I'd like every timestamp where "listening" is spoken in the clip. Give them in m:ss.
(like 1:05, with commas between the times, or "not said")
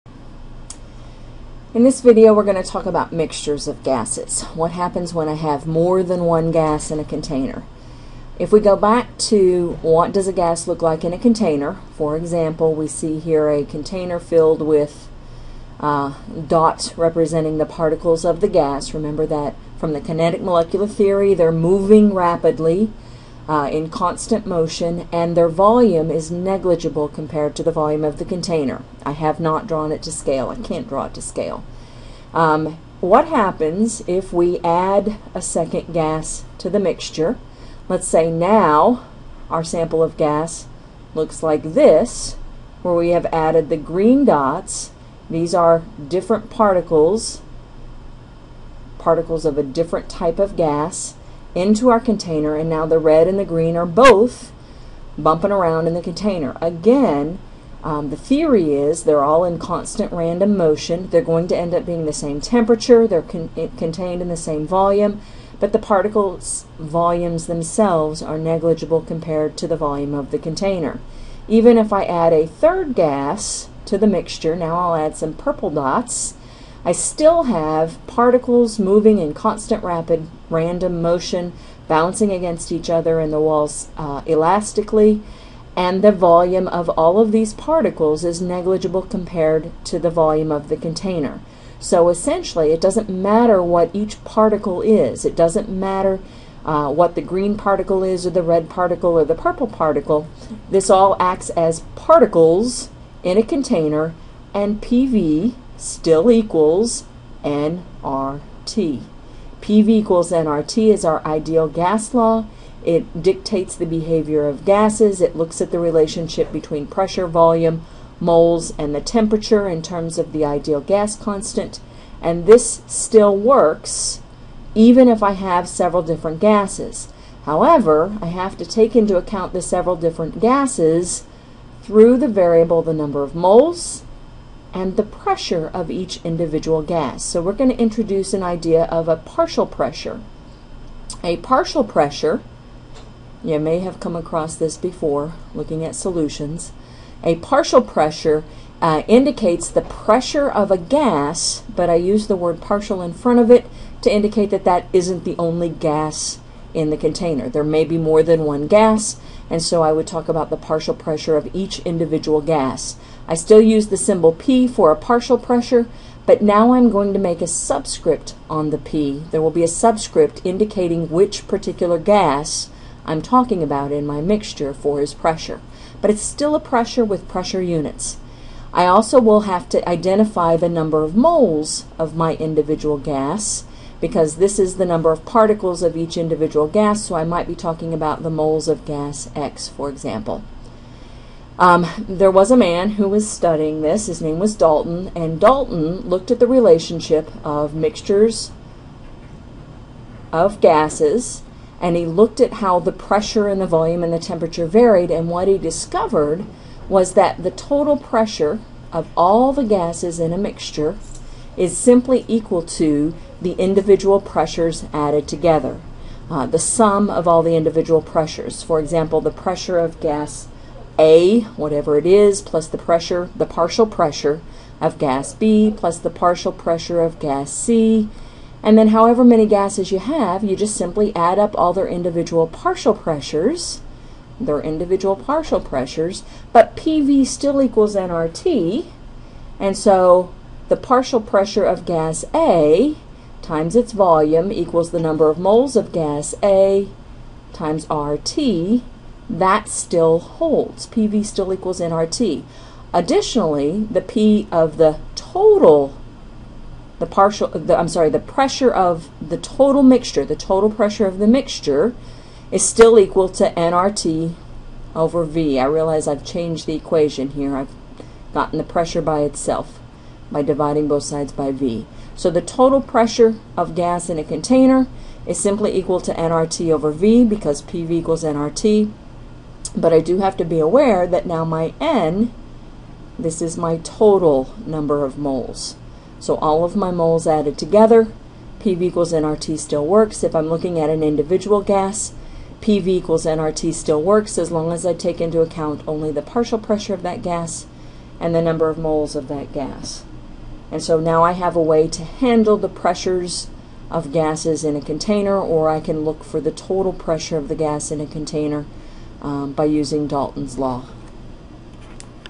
not said.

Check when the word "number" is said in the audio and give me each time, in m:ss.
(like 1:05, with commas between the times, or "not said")
2:12, 3:00, 3:04, 4:05, 4:44, 4:58.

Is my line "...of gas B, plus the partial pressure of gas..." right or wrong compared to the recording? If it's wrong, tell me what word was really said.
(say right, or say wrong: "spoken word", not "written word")
right.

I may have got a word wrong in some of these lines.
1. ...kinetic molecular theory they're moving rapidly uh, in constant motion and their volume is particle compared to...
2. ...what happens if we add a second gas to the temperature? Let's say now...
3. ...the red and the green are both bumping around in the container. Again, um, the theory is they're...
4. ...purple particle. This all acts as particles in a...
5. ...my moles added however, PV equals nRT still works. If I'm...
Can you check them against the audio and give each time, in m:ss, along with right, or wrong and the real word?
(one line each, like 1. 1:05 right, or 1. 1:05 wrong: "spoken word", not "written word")
1. 0:20 wrong: "negligible", not "particle"
2. 0:33 wrong: "mixture", not "temperature"
3. 0:52 right
4. 1:39 right
5. 4:46 wrong: "together", not "however".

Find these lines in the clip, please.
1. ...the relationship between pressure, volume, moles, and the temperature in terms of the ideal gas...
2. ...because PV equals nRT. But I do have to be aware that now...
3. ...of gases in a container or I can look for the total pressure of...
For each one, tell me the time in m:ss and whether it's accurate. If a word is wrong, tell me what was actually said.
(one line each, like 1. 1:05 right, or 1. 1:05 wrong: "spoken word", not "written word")
1. 1:55 right
2. 4:37 right
3. 5:03 right.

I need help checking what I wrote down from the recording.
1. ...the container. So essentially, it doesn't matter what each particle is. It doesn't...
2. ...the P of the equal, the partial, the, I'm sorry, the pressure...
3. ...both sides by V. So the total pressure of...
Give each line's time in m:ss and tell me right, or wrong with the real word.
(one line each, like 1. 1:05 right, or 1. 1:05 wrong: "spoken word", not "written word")
1. 1:30 right
2. 4:13 wrong: "total", not "equal"
3. 4:30 right.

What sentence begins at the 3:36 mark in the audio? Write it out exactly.
Uh, the sum of all the individual pressures.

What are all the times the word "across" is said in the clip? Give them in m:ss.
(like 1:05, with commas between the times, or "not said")
2:24.